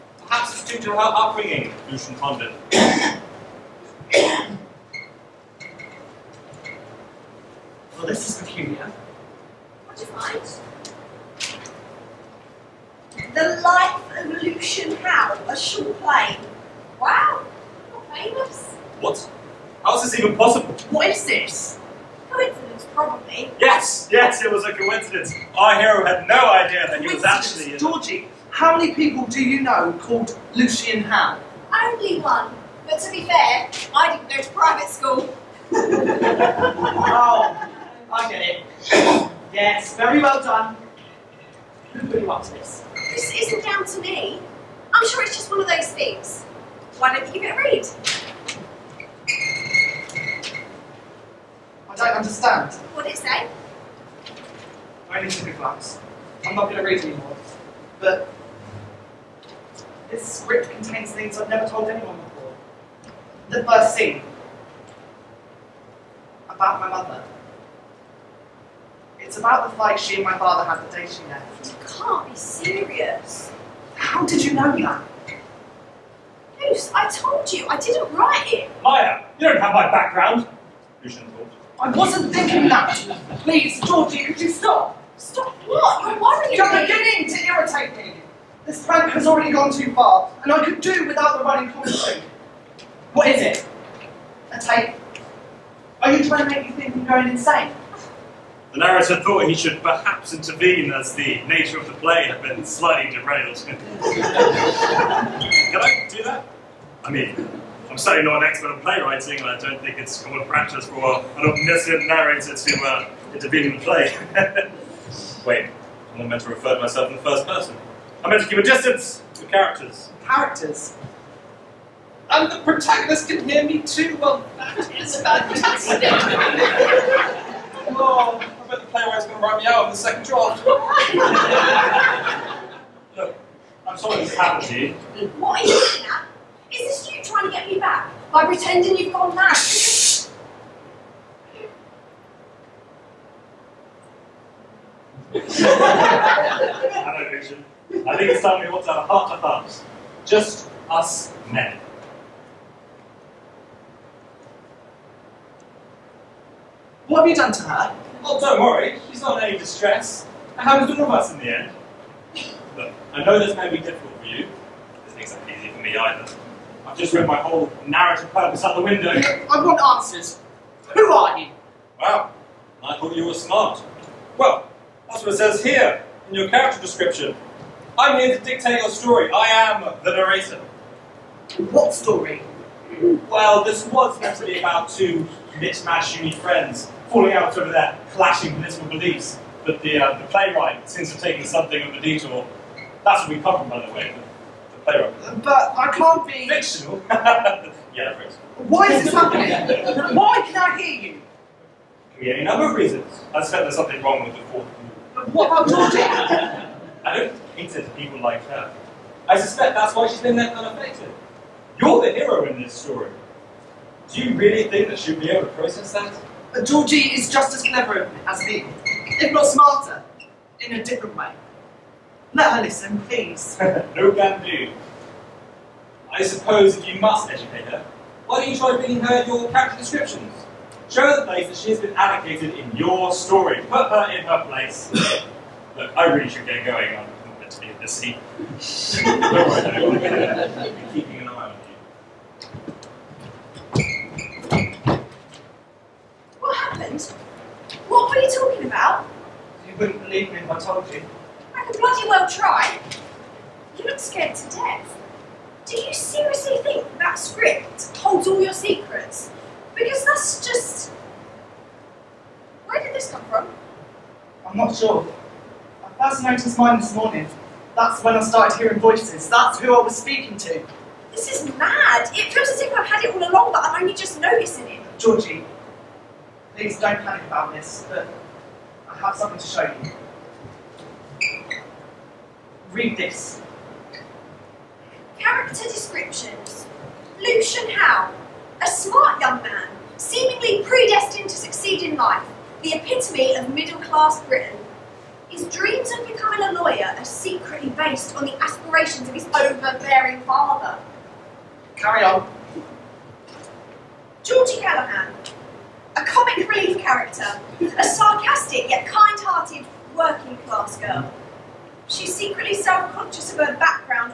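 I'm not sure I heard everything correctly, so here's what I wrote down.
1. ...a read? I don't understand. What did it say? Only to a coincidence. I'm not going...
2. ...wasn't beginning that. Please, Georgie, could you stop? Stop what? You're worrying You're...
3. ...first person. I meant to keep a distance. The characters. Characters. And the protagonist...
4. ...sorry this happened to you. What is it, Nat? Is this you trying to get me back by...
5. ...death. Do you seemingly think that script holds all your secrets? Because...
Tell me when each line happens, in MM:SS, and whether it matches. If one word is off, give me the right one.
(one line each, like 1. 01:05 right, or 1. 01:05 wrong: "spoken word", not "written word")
1. 00:47 wrong: "glance", not "coincidence"
2. 01:21 wrong: "thinking", not "beginning"
3. 01:57 right
4. 02:13 right
5. 04:14 wrong: "seriously", not "seemingly".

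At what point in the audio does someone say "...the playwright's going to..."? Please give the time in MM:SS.
02:08.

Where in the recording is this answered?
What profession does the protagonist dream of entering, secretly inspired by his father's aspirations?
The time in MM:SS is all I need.
04:56.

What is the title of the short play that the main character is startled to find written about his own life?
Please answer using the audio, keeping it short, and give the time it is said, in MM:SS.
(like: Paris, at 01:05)
The Life of Lucian Howe, at 00:13.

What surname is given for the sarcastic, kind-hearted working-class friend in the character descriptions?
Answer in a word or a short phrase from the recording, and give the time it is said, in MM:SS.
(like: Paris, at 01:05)
Callahan, at 05:04.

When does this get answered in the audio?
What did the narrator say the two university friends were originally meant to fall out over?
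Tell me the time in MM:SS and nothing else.
03:08.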